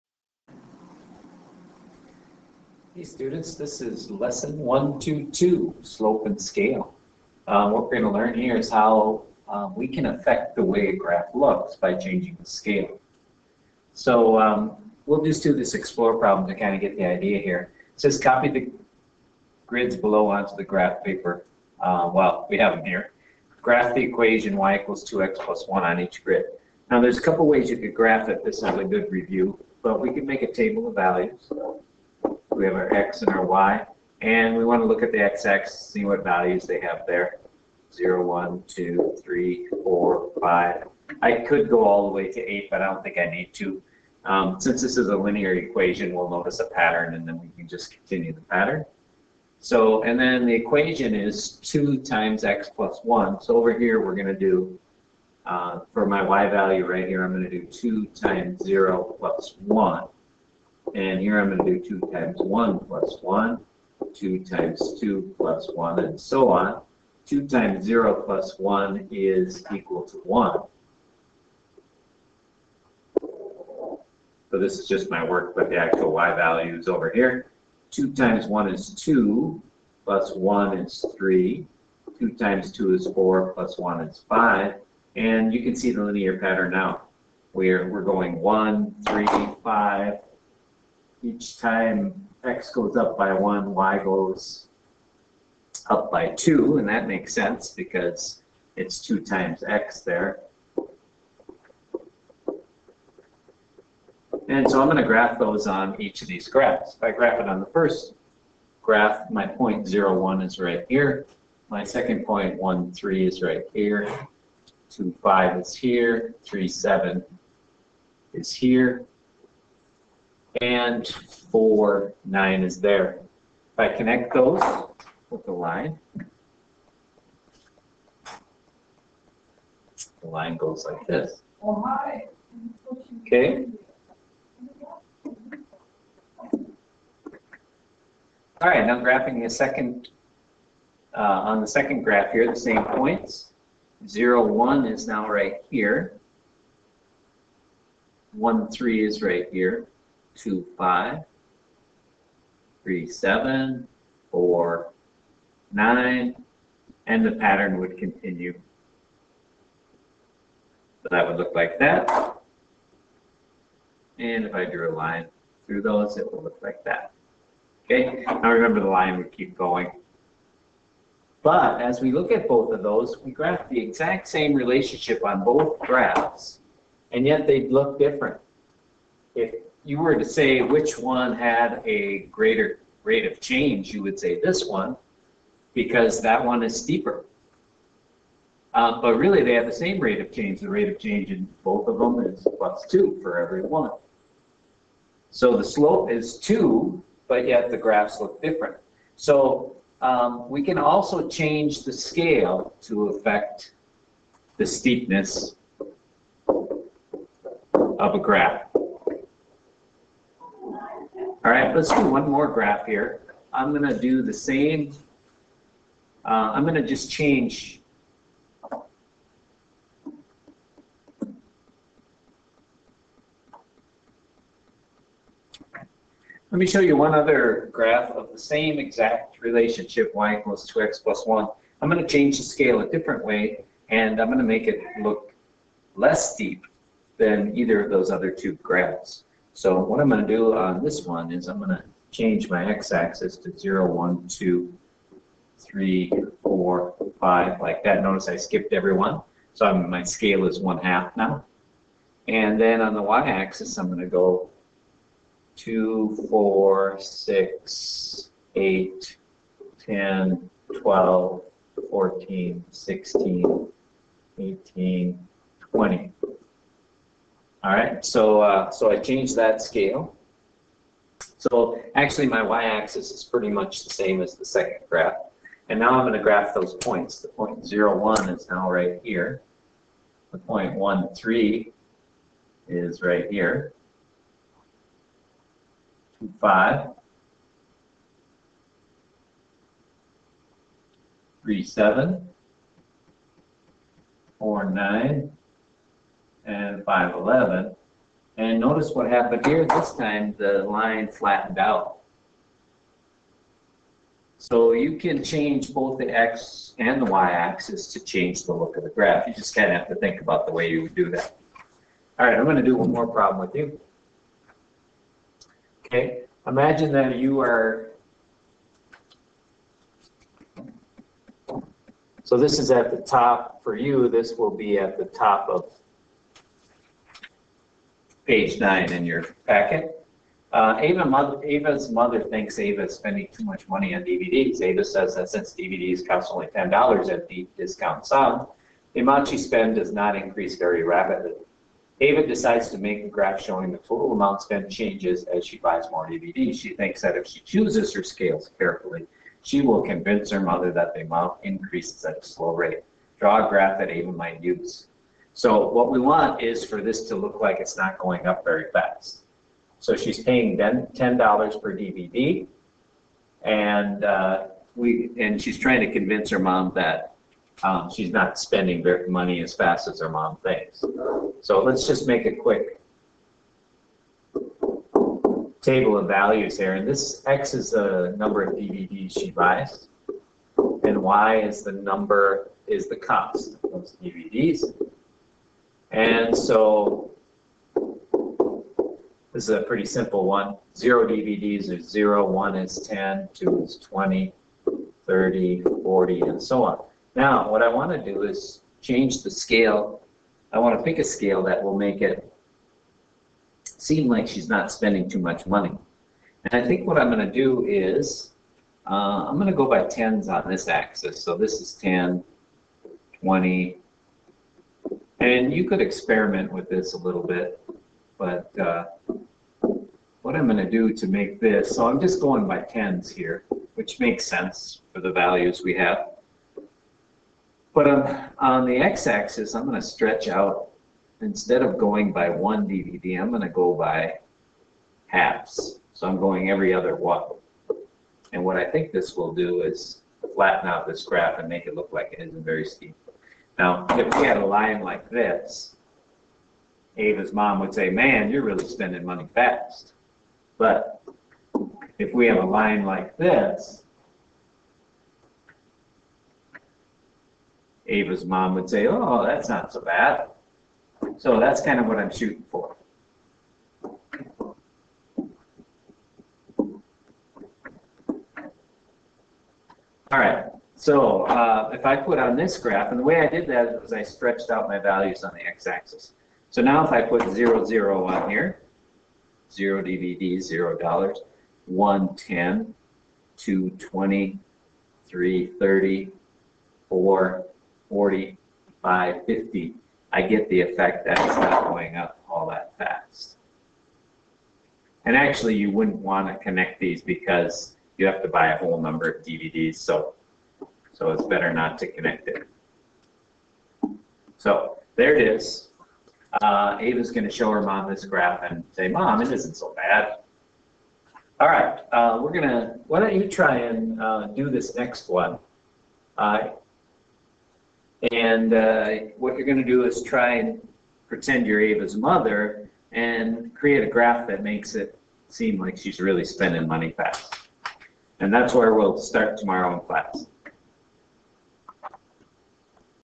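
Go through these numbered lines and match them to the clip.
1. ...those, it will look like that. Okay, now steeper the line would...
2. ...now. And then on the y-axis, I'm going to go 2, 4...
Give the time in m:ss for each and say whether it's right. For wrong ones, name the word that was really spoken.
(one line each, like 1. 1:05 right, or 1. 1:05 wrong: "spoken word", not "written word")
1. 2:45 wrong: "remember", not "steeper"
2. 4:11 right.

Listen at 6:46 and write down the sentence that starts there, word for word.
And I think what I'm going to do is, uh, I'm going to go by tens on this axis.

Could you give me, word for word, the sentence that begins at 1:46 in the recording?
If I graph it on the first graph, my point zero is right here.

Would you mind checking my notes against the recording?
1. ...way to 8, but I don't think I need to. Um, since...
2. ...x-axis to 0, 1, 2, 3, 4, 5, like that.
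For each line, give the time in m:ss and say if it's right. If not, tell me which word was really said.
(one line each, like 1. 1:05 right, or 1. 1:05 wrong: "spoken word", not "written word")
1. 0:42 right
2. 4:02 right.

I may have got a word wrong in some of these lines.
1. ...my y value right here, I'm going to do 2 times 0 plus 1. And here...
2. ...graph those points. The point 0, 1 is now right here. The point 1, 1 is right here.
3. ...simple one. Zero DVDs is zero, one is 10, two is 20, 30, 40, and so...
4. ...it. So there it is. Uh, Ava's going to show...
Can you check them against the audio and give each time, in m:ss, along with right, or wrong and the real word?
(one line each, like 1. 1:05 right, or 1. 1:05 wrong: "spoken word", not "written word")
1. 0:56 right
2. 4:36 wrong: "3", not "1"
3. 6:29 right
4. 8:22 right.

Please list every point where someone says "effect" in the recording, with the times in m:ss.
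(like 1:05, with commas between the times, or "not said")
8:10.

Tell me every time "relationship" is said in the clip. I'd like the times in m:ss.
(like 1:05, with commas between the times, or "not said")
2:54, 3:49.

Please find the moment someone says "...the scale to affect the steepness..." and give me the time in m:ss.
3:21.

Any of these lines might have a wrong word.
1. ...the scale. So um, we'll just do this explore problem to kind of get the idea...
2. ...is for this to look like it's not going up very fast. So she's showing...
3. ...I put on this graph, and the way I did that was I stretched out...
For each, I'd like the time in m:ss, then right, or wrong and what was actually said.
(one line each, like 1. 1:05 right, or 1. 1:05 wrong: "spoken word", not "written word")
1. 0:12 right
2. 5:56 wrong: "paying", not "showing"
3. 7:51 right.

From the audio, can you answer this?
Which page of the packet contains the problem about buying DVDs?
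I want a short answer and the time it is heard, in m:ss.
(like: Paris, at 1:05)
page 9, at 5:28.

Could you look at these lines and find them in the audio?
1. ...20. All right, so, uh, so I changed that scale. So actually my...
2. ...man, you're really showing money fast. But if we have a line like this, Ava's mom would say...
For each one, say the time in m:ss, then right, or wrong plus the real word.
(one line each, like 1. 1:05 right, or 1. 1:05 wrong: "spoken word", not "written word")
1. 4:25 right
2. 7:27 wrong: "spending", not "showing".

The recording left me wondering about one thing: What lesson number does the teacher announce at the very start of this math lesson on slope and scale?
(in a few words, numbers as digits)
122.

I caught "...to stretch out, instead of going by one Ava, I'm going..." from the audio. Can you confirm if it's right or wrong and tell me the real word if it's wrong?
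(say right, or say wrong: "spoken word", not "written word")
wrong: "DVD", not "Ava".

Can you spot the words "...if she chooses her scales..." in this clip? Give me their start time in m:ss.
5:47.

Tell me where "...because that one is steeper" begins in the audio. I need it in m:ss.
3:05.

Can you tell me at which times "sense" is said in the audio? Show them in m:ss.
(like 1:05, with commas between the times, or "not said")
1:37, 7:04.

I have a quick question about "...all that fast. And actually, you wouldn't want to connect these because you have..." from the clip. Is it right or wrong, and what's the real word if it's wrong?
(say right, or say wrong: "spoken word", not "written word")
right.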